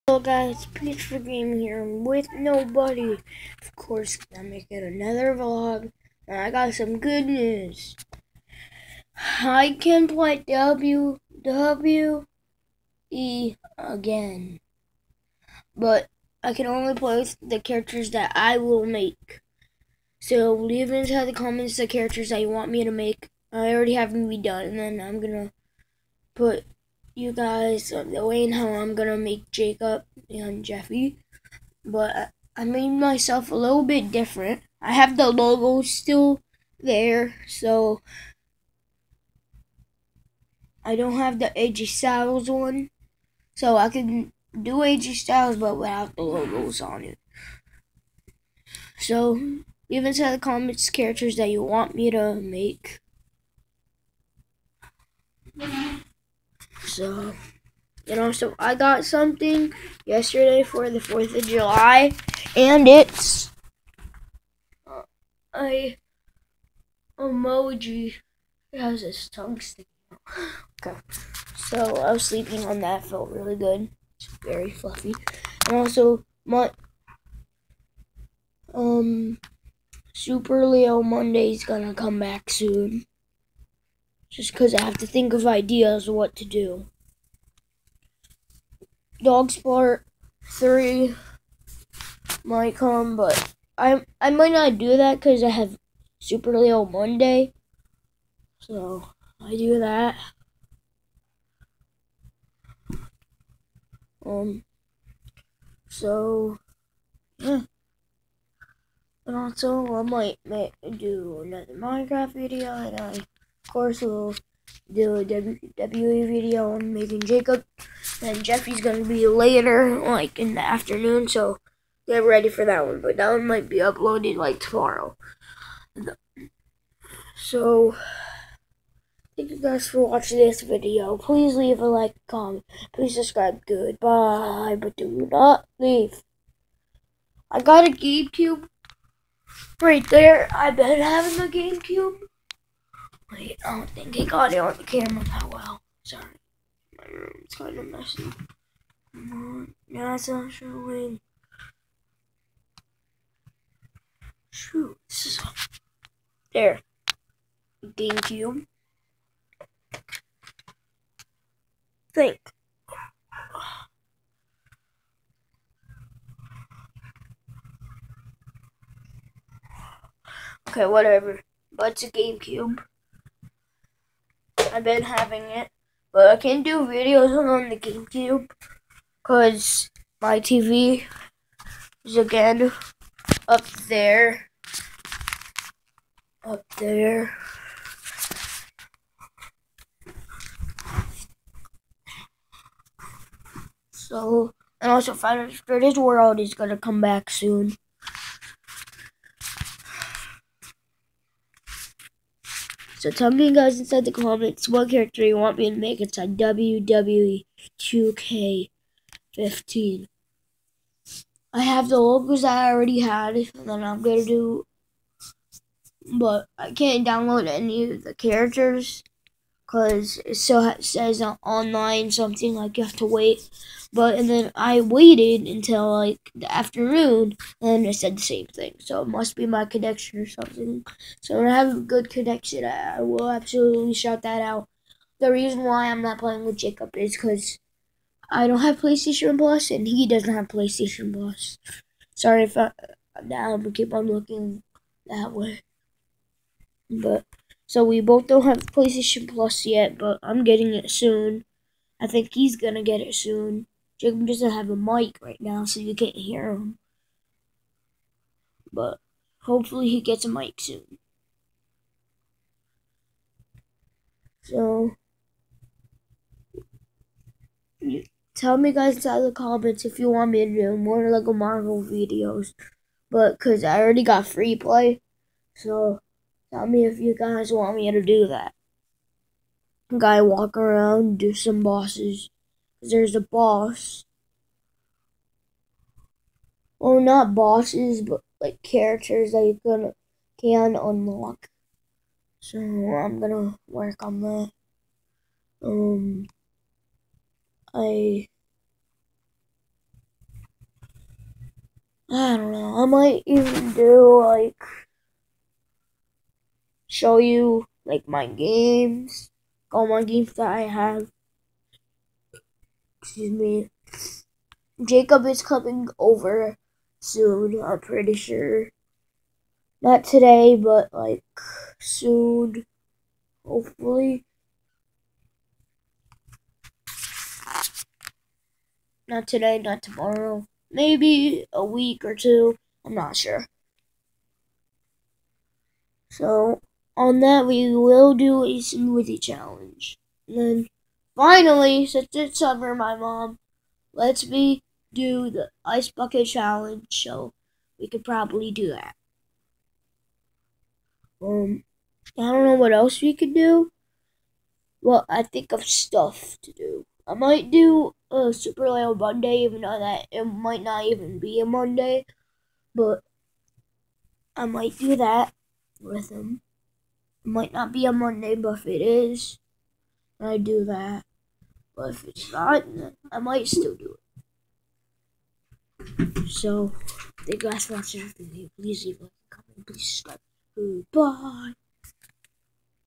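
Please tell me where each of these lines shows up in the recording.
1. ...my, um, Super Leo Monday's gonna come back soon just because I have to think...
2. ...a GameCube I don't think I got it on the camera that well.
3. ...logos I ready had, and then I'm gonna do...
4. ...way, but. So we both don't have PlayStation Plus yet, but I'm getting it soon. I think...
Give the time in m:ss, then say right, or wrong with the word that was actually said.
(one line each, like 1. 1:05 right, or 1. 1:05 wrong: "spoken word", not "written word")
1. 1:16 right
2. 2:21 right
3. 3:31 wrong: "already", not "ready"
4. 4:05 right.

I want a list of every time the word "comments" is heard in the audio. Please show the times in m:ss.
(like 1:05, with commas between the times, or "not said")
0:21, 0:50, 2:12, 3:24, 4:29, 6:19.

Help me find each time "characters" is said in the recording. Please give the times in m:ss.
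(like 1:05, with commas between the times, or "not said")
0:17, 0:21, 0:50, 3:24, 3:38, 4:48.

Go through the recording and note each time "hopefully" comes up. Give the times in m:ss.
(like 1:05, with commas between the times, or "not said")
4:19, 5:23.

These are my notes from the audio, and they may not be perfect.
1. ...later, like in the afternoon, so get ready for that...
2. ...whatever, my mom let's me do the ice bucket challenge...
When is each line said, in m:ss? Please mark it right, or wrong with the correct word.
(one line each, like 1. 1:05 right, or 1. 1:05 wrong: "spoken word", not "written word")
1. 1:59 right
2. 5:42 wrong: "summer", not "whatever".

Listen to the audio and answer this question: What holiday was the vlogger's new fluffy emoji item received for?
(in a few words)
4th of July.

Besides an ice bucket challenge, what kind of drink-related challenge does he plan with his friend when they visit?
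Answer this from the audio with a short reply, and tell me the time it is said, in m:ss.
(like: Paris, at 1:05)
smoothie challenge, at 5:38.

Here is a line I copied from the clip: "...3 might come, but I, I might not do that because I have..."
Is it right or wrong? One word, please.
right.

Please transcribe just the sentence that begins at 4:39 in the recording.
Guy walk around, do some bosses.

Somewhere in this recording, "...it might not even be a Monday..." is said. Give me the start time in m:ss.
6:00.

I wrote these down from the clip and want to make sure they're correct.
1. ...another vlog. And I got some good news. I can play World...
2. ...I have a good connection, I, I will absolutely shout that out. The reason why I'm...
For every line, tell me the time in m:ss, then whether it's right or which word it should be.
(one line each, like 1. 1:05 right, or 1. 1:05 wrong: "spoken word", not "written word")
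1. 0:04 wrong: "WWE", not "World"
2. 3:51 right.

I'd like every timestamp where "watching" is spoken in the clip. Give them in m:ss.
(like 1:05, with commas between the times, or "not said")
2:10, 6:17.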